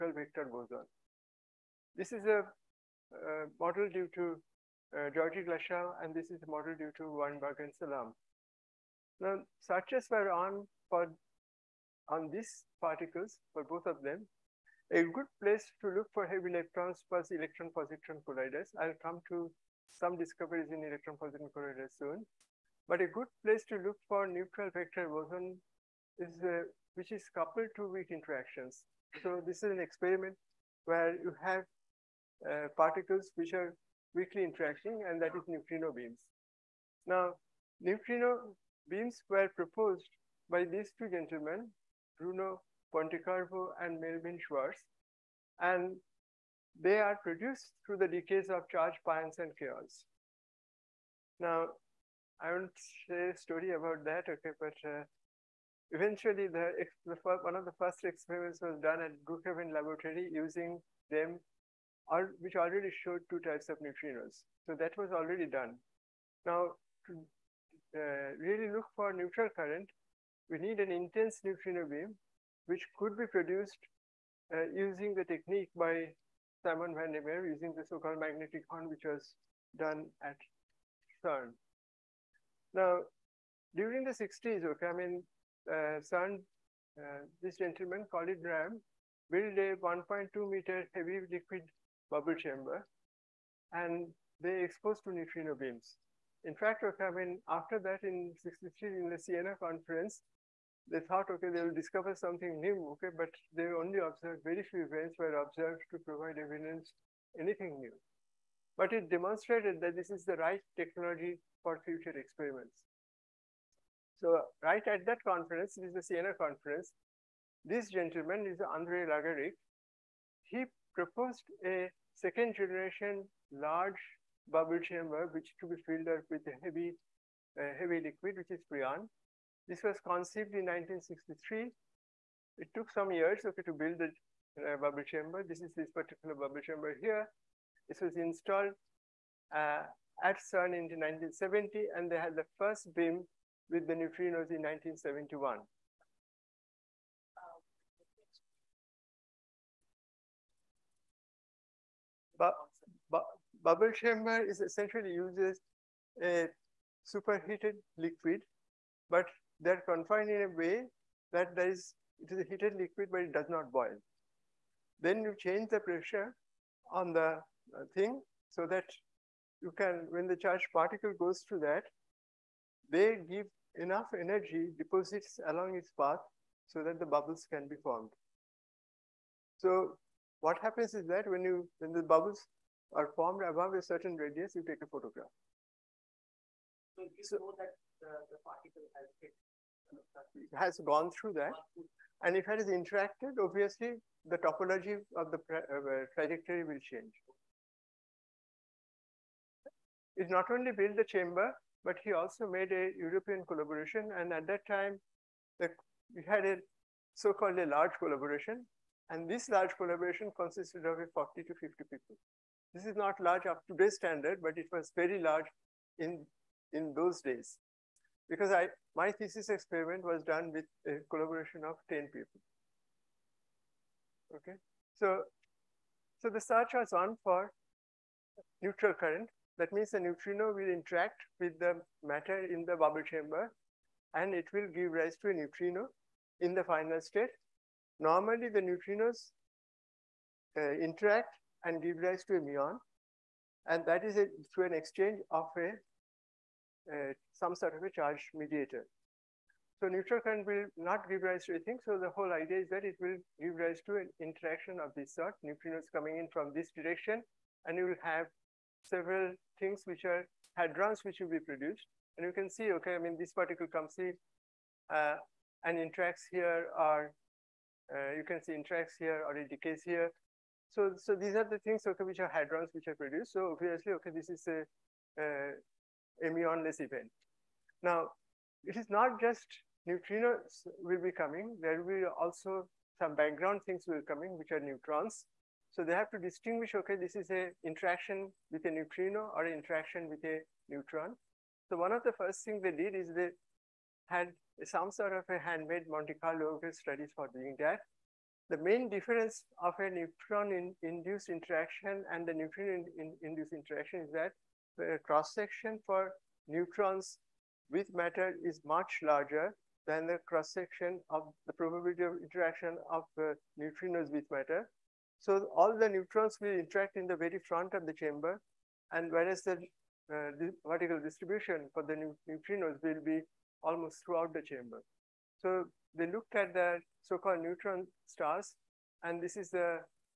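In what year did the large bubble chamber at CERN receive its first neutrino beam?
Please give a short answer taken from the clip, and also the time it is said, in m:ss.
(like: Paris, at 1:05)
1971, at 2:24.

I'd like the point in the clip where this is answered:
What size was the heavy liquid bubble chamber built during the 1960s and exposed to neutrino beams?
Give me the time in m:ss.
1:29.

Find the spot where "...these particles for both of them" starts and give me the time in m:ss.
0:12.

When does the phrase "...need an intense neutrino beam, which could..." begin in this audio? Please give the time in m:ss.
1:10.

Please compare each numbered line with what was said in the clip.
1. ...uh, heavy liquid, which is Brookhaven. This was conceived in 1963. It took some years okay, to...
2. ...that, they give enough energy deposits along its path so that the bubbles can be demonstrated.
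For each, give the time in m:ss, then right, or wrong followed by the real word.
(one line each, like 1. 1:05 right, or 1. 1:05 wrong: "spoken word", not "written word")
1. 2:07 wrong: "Freon", not "Brookhaven"
2. 2:51 wrong: "formed", not "demonstrated".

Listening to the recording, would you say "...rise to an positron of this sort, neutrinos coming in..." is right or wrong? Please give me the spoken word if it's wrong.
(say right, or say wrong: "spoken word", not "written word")
wrong: "interaction", not "positron".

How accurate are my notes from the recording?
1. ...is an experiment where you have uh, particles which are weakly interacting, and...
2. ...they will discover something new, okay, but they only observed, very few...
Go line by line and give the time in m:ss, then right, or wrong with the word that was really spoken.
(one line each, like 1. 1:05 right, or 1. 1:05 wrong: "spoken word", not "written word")
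1. 0:29 right
2. 1:41 right.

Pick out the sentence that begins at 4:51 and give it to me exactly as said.
So one of the first things they did is they had some sort of a handmade Monte Carlo studies for doing that.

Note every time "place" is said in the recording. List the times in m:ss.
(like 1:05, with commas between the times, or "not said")
0:15, 0:23.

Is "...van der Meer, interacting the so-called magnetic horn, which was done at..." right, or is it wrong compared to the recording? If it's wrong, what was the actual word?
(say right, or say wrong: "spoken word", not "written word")
wrong: "using", not "interacting".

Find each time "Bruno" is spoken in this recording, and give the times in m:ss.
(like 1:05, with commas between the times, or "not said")
0:42.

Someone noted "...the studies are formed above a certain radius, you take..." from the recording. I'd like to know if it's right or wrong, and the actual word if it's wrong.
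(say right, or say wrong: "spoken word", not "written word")
wrong: "bubbles", not "studies".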